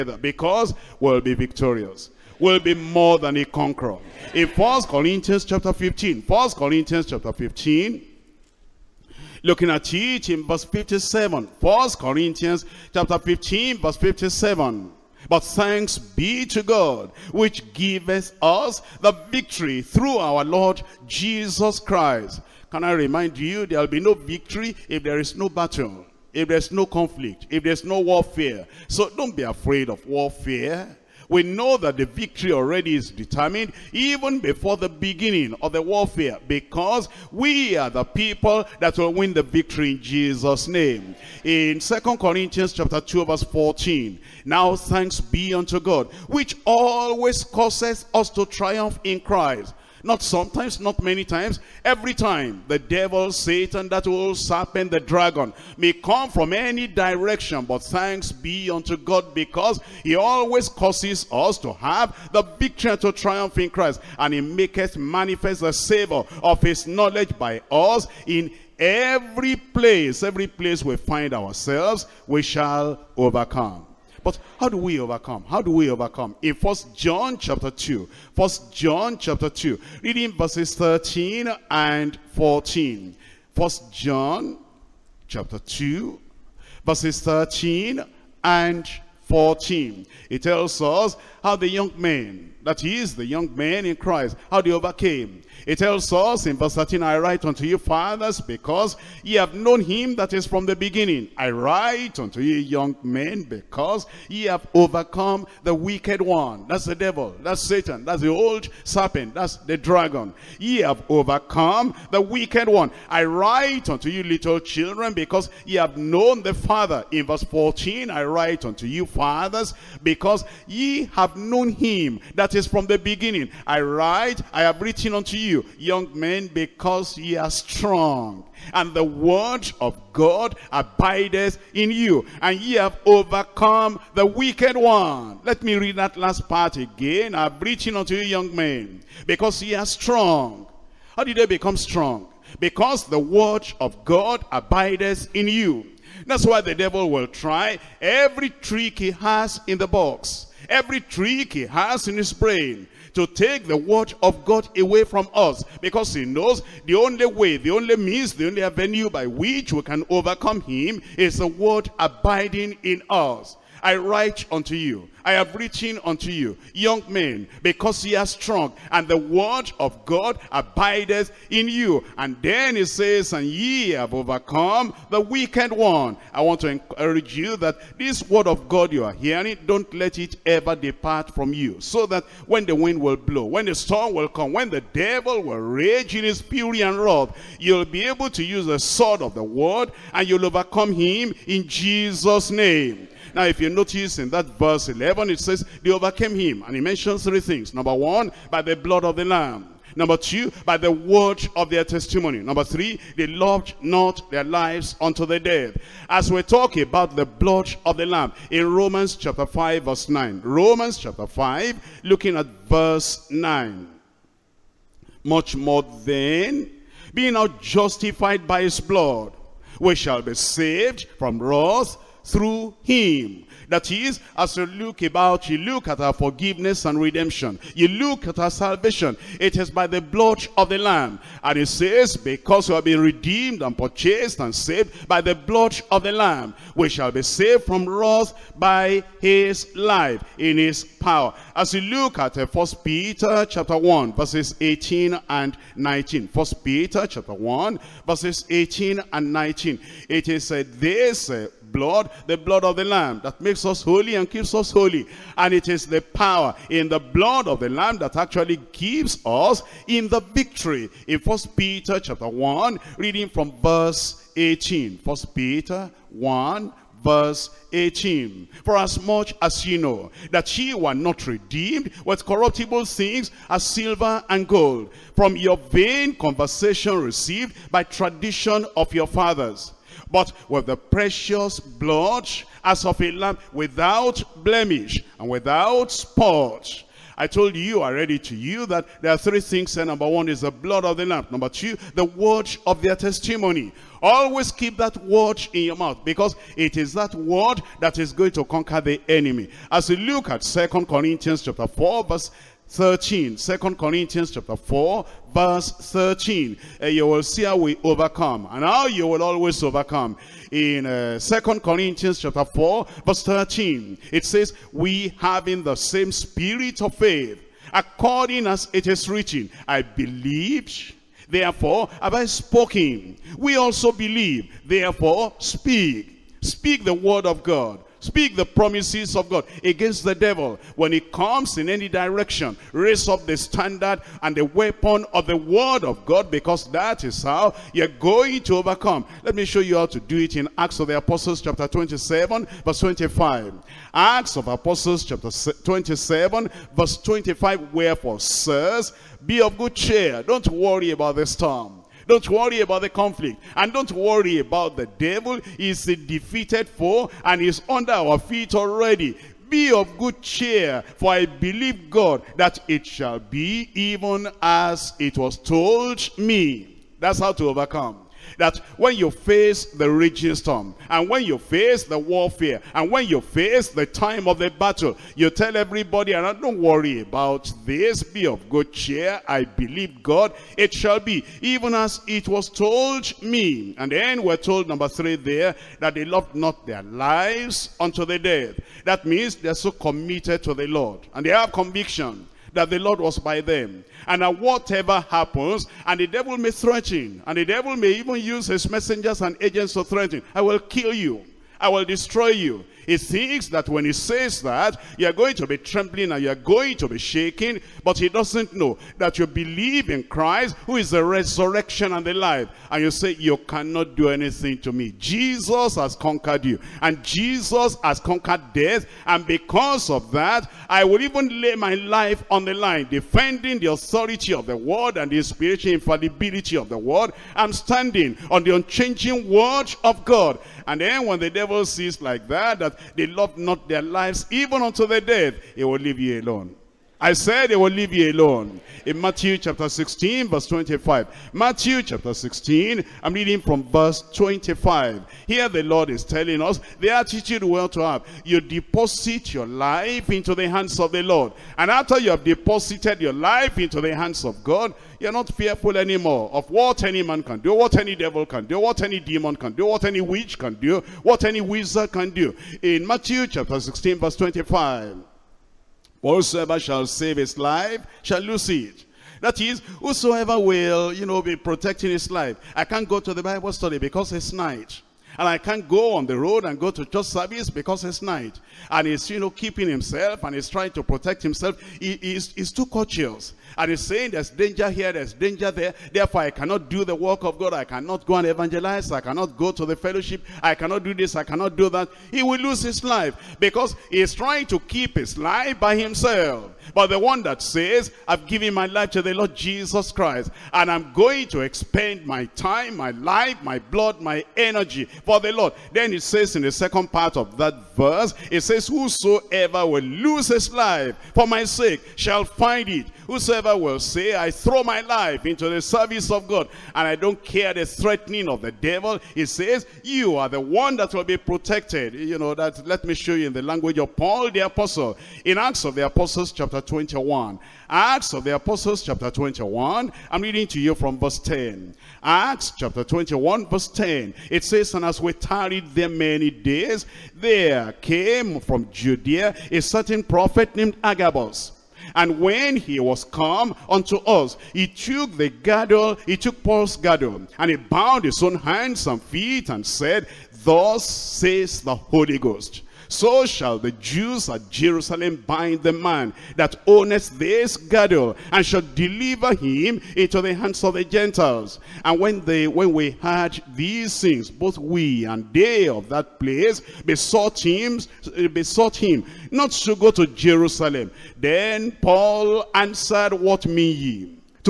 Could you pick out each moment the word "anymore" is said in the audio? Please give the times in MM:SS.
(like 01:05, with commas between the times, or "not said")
07:35.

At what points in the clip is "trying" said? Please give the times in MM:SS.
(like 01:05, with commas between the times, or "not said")
08:00, 08:14.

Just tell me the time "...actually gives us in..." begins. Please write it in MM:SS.
04:18.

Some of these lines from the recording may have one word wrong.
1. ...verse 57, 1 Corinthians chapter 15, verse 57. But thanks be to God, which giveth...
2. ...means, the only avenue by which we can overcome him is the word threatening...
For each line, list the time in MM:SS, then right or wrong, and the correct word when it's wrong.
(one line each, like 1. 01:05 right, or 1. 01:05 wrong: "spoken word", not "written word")
1. 00:10 right
2. 02:37 wrong: "abiding", not "threatening".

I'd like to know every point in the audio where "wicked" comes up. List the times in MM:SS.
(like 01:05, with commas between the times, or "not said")
01:45, 01:52, 02:14, 02:55.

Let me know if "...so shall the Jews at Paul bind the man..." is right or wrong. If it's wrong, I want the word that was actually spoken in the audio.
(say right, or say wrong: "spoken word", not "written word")
wrong: "Jerusalem", not "Paul".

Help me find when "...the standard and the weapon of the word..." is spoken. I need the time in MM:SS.
05:33.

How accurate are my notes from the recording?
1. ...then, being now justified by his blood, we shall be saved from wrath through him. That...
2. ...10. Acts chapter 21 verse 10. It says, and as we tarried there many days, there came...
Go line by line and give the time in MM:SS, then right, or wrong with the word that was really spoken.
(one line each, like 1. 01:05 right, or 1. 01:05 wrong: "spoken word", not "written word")
1. 03:36 right
2. 08:51 right.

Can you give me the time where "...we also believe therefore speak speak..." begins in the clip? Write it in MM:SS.
05:23.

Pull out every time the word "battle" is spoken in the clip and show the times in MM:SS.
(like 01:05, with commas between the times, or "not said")
00:25, 06:14.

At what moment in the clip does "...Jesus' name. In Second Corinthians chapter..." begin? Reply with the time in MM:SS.
00:40.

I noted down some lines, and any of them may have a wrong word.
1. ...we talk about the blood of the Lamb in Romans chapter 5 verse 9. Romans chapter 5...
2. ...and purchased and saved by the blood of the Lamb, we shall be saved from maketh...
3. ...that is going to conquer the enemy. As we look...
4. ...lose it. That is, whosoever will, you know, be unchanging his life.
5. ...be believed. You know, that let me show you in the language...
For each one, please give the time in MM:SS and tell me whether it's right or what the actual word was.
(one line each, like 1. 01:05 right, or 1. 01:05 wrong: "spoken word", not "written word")
1. 03:26 right
2. 03:53 wrong: "wrath", not "maketh"
3. 04:57 right
4. 07:48 wrong: "protecting", not "unchanging"
5. 08:41 wrong: "protected", not "believed".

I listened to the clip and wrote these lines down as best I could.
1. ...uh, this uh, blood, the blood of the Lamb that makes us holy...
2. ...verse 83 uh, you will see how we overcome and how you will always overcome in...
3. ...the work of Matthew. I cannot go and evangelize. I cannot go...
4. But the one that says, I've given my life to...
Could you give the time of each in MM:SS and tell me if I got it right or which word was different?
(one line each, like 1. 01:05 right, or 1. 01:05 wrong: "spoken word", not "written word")
1. 04:10 right
2. 05:05 wrong: "13", not "83"
3. 08:06 wrong: "God", not "Matthew"
4. 08:16 right.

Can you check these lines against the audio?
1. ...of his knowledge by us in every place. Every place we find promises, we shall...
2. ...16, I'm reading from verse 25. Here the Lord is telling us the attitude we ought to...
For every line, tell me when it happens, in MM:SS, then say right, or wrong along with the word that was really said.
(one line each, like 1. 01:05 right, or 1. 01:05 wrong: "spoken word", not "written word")
1. 01:06 wrong: "ourselves", not "promises"
2. 07:22 right.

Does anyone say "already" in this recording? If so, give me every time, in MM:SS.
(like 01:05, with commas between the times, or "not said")
00:32, 04:47, 05:58.